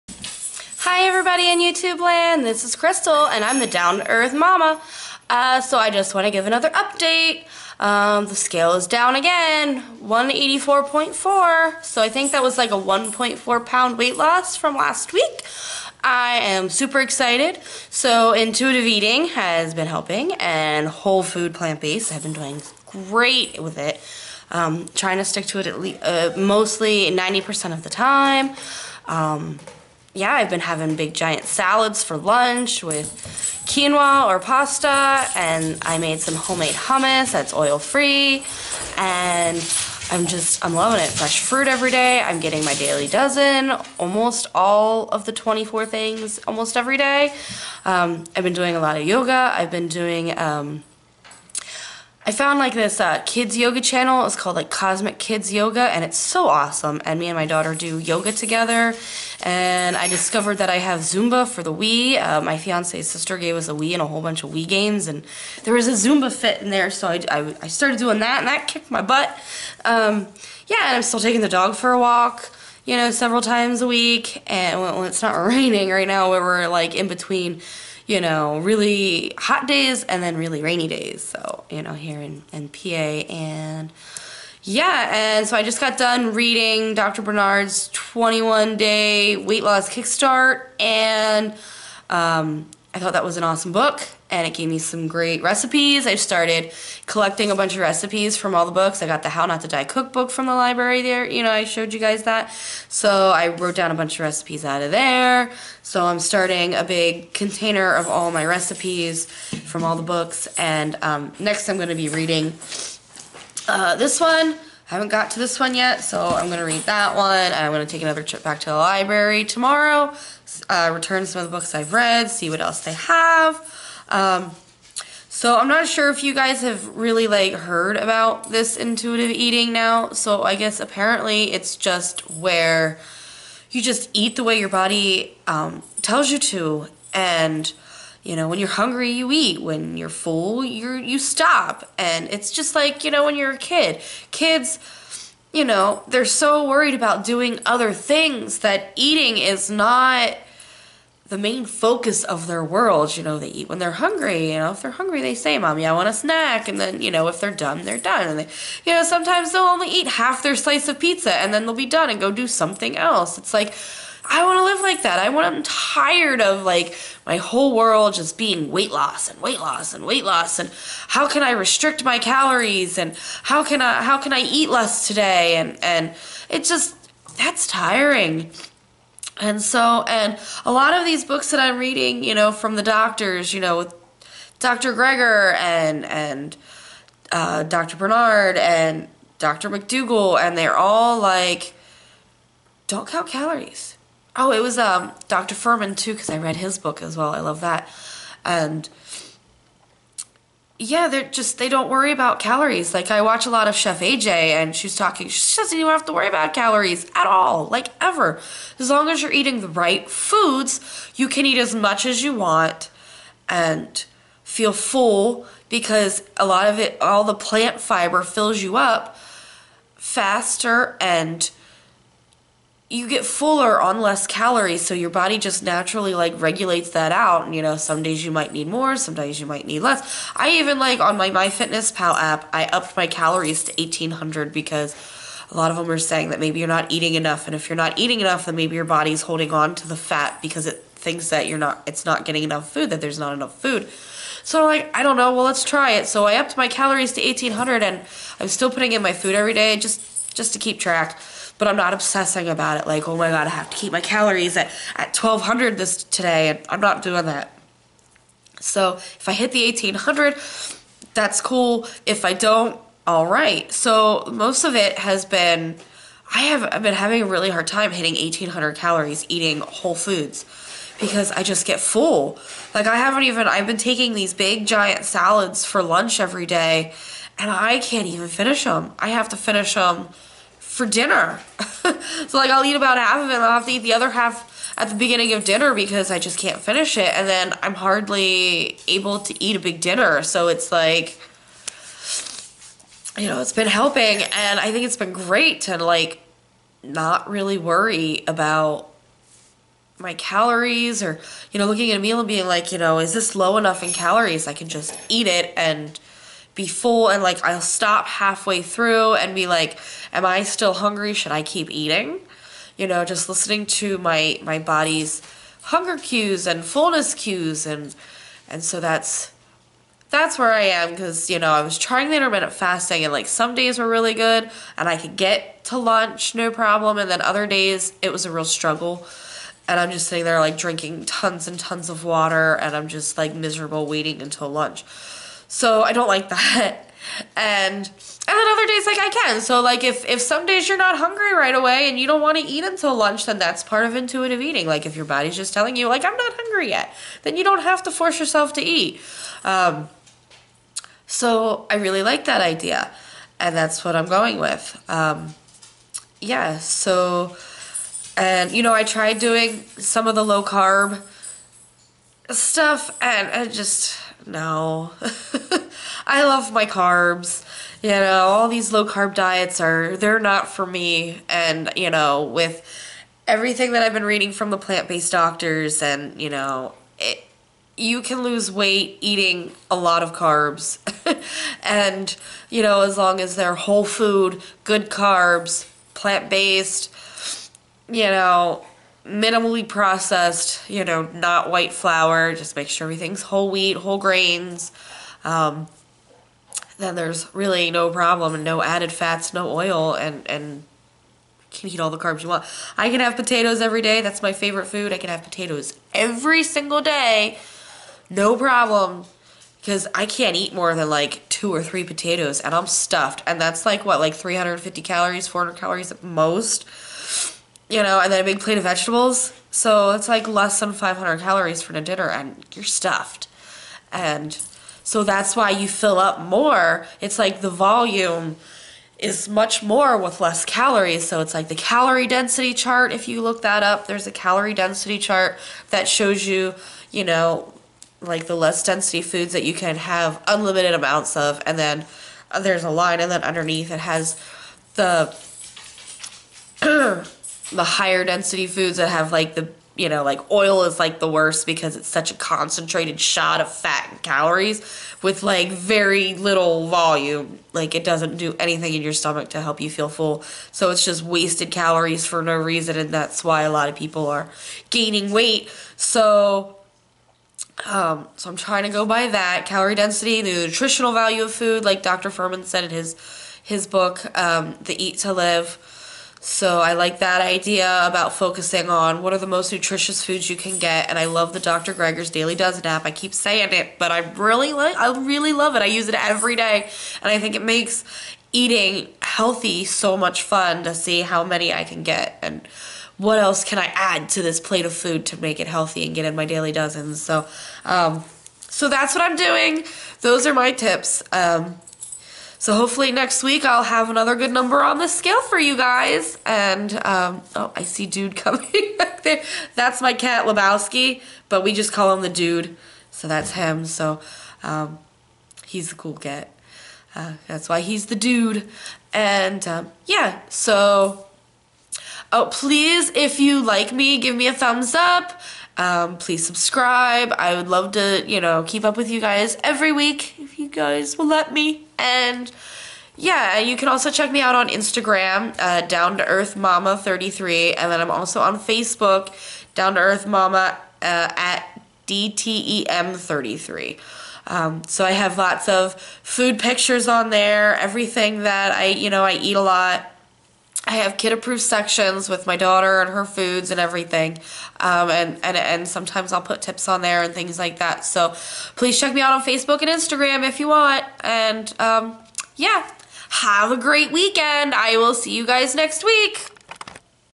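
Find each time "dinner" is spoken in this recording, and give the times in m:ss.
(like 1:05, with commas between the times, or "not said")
4:40, 4:45, 4:49, 7:01.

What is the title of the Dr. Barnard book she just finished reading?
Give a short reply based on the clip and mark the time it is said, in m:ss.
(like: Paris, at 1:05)
21 Day Weight Loss Kickstart, at 1:27.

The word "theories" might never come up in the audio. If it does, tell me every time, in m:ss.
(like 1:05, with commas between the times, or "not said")
not said.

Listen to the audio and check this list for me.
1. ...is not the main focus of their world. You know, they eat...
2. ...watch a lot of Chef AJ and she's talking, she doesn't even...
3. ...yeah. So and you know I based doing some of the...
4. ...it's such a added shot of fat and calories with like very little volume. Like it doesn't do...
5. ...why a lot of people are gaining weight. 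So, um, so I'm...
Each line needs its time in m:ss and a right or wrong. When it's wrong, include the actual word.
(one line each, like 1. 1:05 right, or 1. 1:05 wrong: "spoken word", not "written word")
1. 2:29 right
2. 3:23 right
3. 5:56 wrong: "tried", not "based"
4. 7:31 wrong: "concentrated", not "added"
5. 7:43 right.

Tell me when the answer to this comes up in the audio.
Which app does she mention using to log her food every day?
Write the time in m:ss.
3:51.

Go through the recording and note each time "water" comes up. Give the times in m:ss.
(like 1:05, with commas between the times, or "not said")
5:32.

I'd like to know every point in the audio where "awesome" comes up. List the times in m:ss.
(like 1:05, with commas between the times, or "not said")
0:56, 1:33.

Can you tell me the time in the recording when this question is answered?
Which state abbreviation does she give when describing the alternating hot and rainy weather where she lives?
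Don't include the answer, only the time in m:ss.
1:22.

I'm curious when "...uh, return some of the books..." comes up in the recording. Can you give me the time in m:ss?
2:00.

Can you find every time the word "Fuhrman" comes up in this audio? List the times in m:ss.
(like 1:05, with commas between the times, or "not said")
3:15, 7:52.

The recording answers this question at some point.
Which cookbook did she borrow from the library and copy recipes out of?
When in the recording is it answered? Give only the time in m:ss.
1:39.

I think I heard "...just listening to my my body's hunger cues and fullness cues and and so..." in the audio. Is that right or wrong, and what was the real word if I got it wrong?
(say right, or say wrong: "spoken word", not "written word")
right.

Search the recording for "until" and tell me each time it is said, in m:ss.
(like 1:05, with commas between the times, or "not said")
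5:34, 5:42.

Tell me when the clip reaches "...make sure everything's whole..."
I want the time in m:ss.
6:32.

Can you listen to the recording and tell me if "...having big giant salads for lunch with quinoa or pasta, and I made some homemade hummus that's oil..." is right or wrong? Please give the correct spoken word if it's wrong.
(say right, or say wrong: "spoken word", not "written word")
right.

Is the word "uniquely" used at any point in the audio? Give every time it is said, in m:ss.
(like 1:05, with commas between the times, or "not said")
not said.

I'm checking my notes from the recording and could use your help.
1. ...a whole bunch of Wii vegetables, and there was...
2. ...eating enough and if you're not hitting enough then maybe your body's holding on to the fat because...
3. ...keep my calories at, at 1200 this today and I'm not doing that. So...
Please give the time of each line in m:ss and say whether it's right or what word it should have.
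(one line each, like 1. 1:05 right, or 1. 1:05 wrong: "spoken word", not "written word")
1. 1:04 wrong: "games", not "vegetables"
2. 3:56 wrong: "eating", not "hitting"
3. 4:13 right.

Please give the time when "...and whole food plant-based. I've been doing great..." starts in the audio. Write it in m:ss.
0:20.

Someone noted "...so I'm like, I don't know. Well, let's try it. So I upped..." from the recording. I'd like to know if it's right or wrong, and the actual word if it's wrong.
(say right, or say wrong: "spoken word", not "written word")
right.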